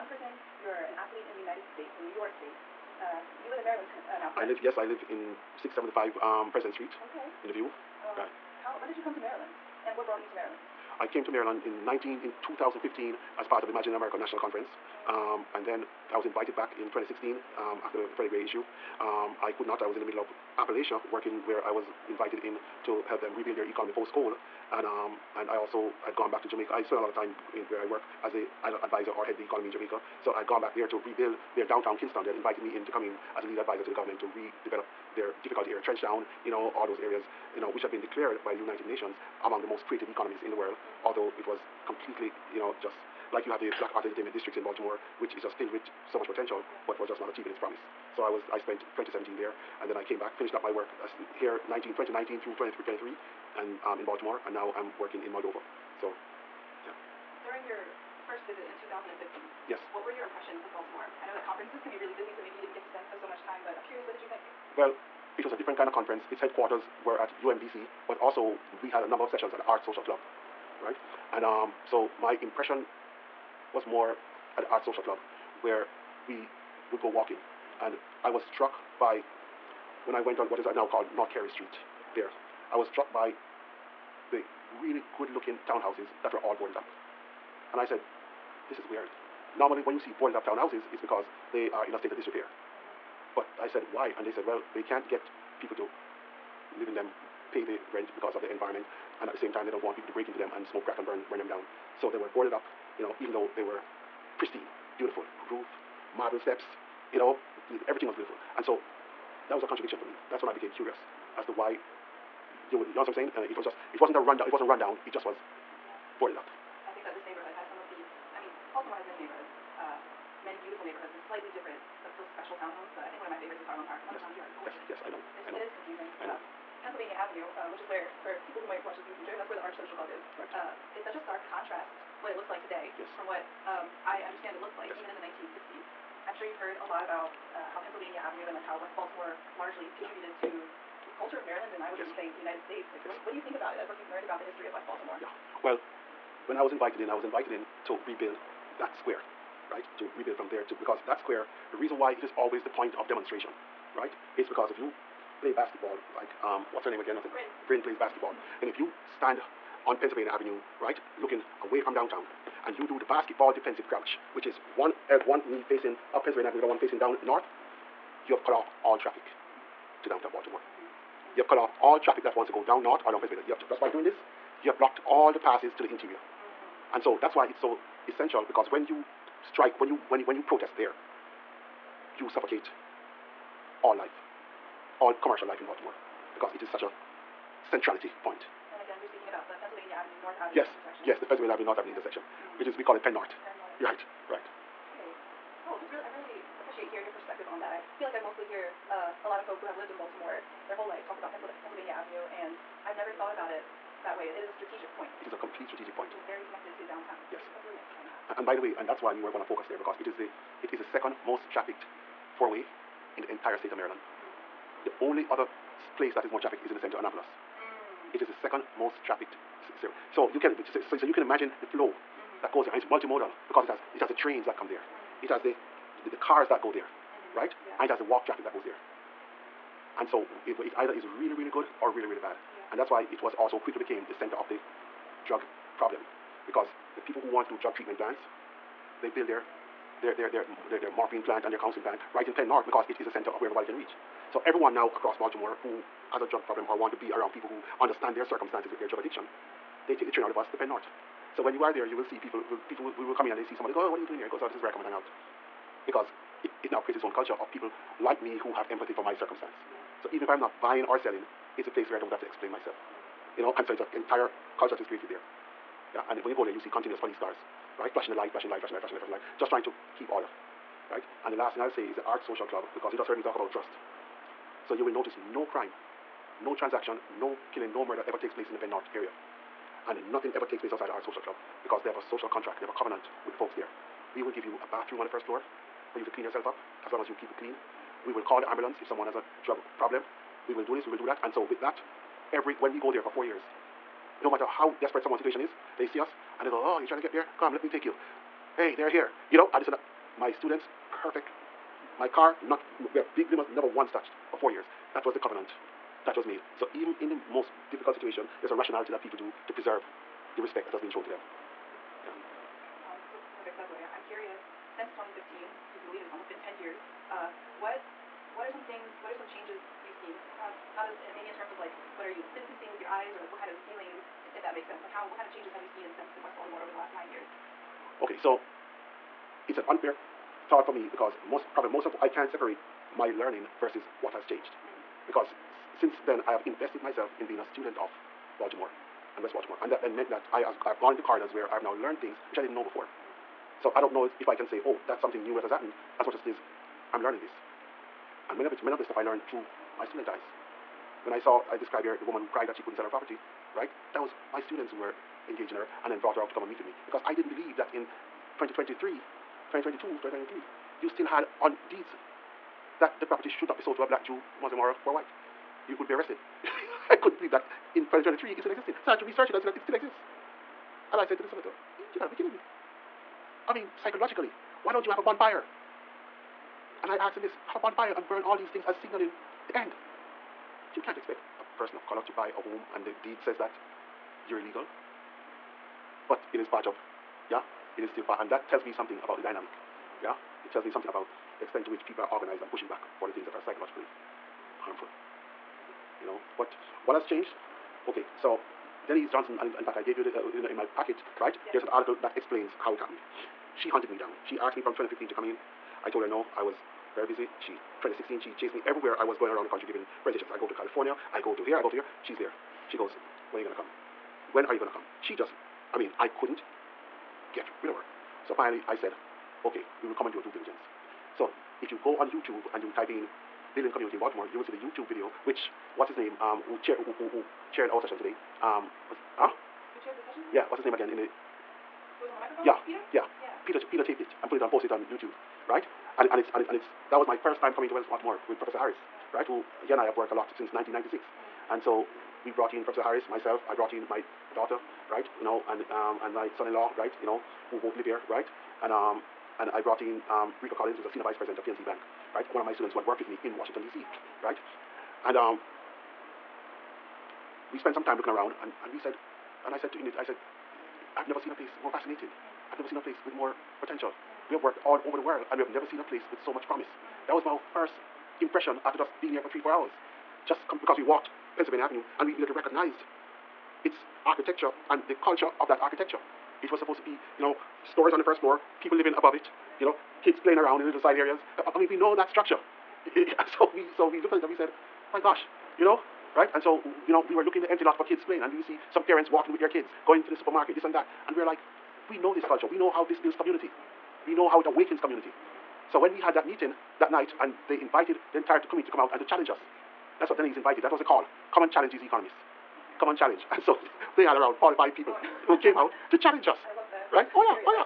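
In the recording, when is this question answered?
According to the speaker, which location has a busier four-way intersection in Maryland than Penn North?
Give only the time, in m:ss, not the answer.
3:36.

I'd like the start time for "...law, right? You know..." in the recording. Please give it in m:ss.
7:26.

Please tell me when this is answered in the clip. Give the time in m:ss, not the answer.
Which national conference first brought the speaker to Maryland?
0:13.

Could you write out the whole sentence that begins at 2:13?
from what um, I understand it looks like yes.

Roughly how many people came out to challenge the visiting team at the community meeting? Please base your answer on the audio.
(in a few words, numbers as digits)
45.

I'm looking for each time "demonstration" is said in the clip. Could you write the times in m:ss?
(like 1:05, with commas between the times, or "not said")
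2:33.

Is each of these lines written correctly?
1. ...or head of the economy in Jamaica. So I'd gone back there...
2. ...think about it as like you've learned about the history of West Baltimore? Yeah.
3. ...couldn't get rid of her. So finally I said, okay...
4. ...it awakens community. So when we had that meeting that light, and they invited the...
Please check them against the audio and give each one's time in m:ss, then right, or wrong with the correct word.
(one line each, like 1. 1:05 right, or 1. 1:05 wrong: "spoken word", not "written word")
1. 0:29 right
2. 2:23 right
3. 6:56 right
4. 8:14 wrong: "night", not "light".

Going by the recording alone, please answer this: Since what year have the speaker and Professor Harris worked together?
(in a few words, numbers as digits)
1996.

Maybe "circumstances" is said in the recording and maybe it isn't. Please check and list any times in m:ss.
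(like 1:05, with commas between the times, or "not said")
4:08, 4:19.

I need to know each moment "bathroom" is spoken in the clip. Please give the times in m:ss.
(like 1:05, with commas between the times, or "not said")
4:44.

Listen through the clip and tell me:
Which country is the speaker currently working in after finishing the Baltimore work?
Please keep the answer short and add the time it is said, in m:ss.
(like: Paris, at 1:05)
Moldova, at 0:55.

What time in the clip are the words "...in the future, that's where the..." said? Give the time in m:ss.
2:09.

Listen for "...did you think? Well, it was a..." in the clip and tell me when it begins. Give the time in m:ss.
1:04.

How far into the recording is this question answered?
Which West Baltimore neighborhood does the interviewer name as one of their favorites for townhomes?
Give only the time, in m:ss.
2:03.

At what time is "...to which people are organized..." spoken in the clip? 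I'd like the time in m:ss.
6:31.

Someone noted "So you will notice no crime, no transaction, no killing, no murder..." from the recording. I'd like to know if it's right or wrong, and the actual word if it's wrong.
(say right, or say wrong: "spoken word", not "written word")
right.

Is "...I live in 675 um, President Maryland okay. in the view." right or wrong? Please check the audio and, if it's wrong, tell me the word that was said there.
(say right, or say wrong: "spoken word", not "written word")
wrong: "Street", not "Maryland".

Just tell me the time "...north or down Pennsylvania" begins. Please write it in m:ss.
2:52.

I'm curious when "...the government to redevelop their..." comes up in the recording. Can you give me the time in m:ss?
0:33.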